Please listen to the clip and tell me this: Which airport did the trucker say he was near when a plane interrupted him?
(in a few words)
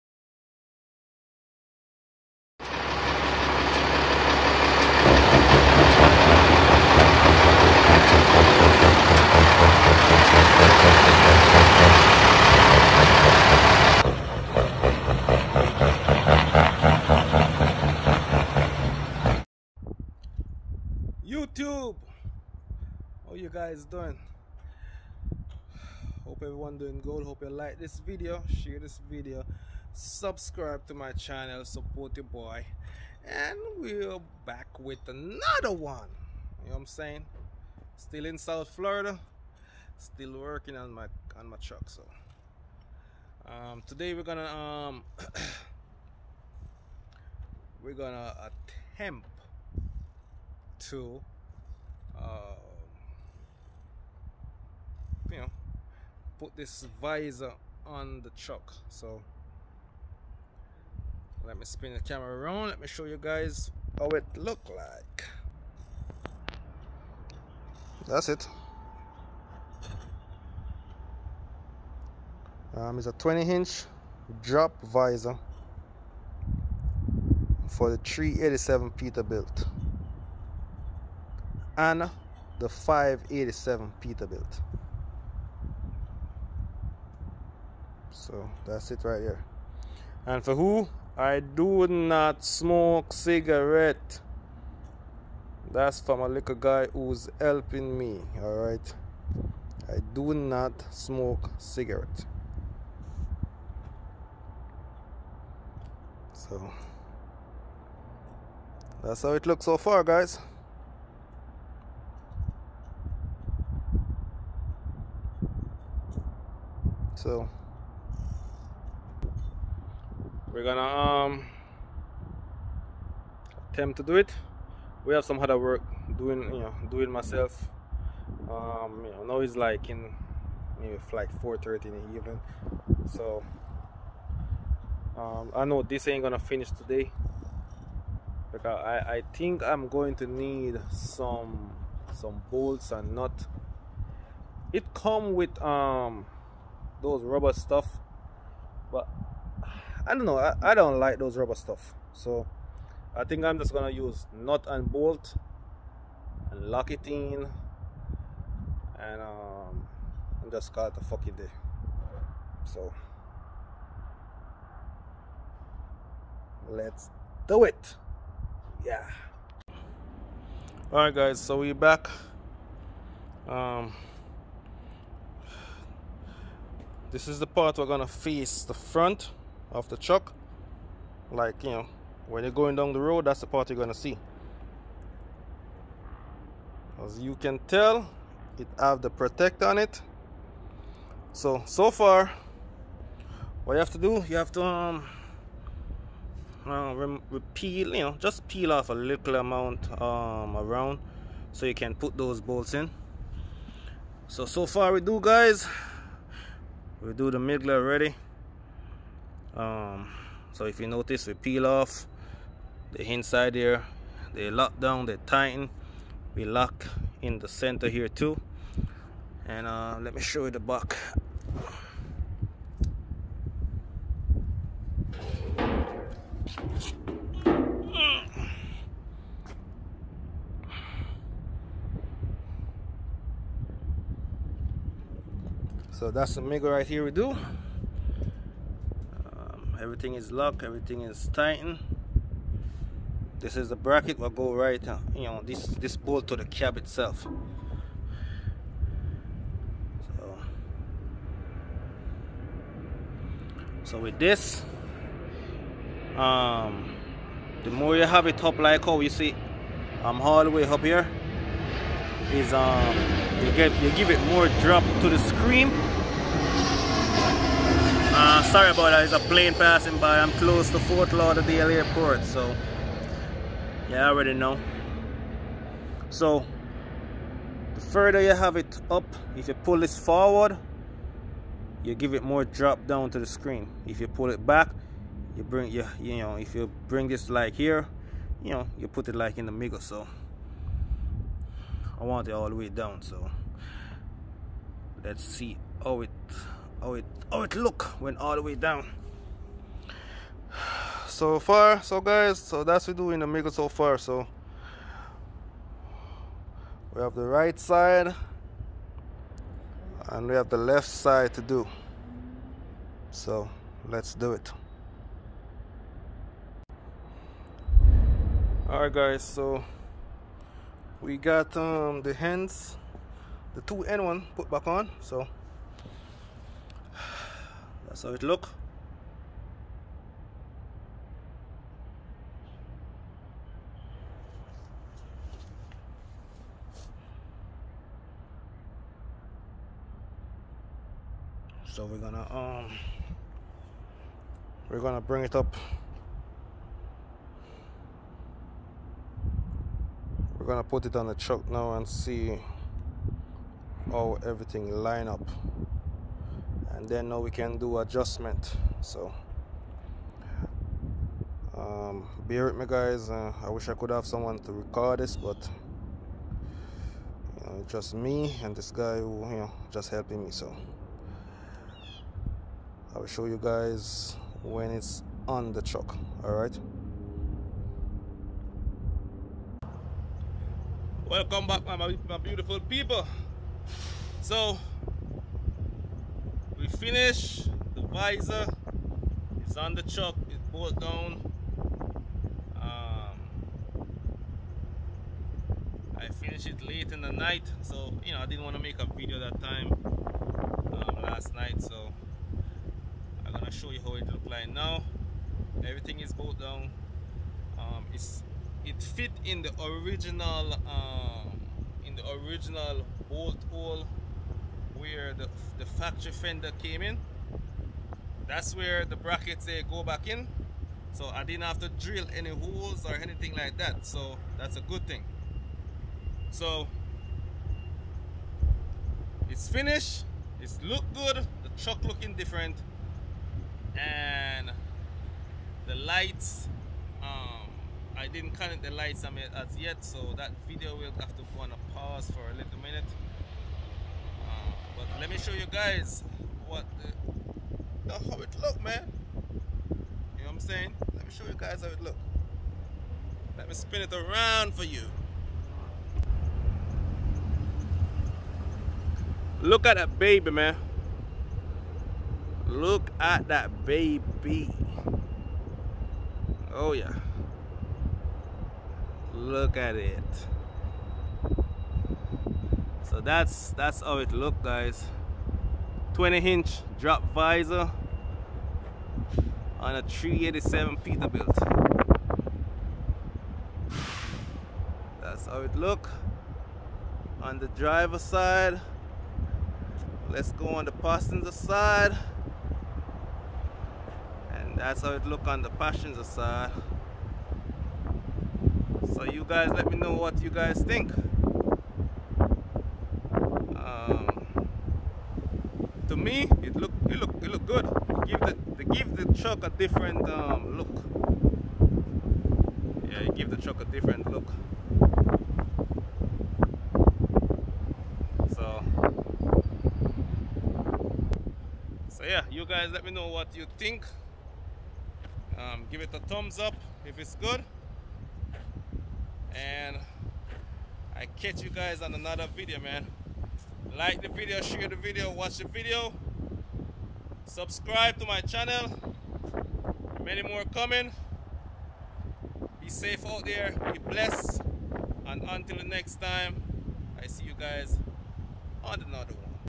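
Fort Lauderdale Airport.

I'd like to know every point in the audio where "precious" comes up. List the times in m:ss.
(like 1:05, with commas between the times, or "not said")
not said.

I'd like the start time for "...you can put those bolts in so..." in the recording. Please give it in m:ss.
3:21.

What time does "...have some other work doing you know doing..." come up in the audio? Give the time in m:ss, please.
2:05.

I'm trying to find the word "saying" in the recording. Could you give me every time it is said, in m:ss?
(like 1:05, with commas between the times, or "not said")
0:36, 7:30.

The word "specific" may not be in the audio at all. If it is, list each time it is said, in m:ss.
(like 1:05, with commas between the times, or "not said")
not said.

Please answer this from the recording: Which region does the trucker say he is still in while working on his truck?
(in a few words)
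South Florida.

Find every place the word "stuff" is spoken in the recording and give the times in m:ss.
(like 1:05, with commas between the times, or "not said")
2:27, 2:31.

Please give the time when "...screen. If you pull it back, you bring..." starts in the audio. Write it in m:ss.
4:43.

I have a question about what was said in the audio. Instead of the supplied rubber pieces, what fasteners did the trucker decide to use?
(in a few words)
nut and bolt.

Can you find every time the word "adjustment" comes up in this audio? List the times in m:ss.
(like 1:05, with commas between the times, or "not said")
5:57.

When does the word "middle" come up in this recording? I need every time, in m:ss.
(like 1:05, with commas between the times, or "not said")
3:27, 4:49, 5:03.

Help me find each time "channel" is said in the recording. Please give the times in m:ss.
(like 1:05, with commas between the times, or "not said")
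0:31, 8:58.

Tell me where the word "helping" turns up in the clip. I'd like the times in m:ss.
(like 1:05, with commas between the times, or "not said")
1:37, 6:09.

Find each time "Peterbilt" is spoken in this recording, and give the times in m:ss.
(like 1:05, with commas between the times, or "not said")
1:18, 1:24, 8:00.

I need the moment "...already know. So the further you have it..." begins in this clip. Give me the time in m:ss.
4:34.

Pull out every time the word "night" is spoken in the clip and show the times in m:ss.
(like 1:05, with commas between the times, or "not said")
6:37, 6:41.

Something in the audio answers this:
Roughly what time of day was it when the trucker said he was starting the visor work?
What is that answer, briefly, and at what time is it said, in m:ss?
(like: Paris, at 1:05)
4:30 in the evening, at 2:11.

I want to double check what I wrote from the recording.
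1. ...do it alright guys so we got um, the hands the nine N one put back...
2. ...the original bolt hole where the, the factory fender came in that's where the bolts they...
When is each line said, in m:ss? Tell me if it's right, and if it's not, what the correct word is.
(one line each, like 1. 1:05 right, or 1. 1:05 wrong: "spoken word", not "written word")
1. 5:14 wrong: "two", not "nine"
2. 6:51 wrong: "brackets", not "bolts".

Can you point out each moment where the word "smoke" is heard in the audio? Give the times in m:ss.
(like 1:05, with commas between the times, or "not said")
1:32, 1:40.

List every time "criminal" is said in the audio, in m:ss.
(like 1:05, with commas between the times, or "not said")
not said.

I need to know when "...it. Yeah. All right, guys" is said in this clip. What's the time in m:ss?
2:47.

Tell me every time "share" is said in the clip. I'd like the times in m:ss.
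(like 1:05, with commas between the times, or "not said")
0:28, 8:54.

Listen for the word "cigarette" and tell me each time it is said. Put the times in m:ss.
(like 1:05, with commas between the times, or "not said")
1:33, 1:41.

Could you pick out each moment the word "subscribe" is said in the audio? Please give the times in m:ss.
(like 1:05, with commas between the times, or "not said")
0:29, 8:57.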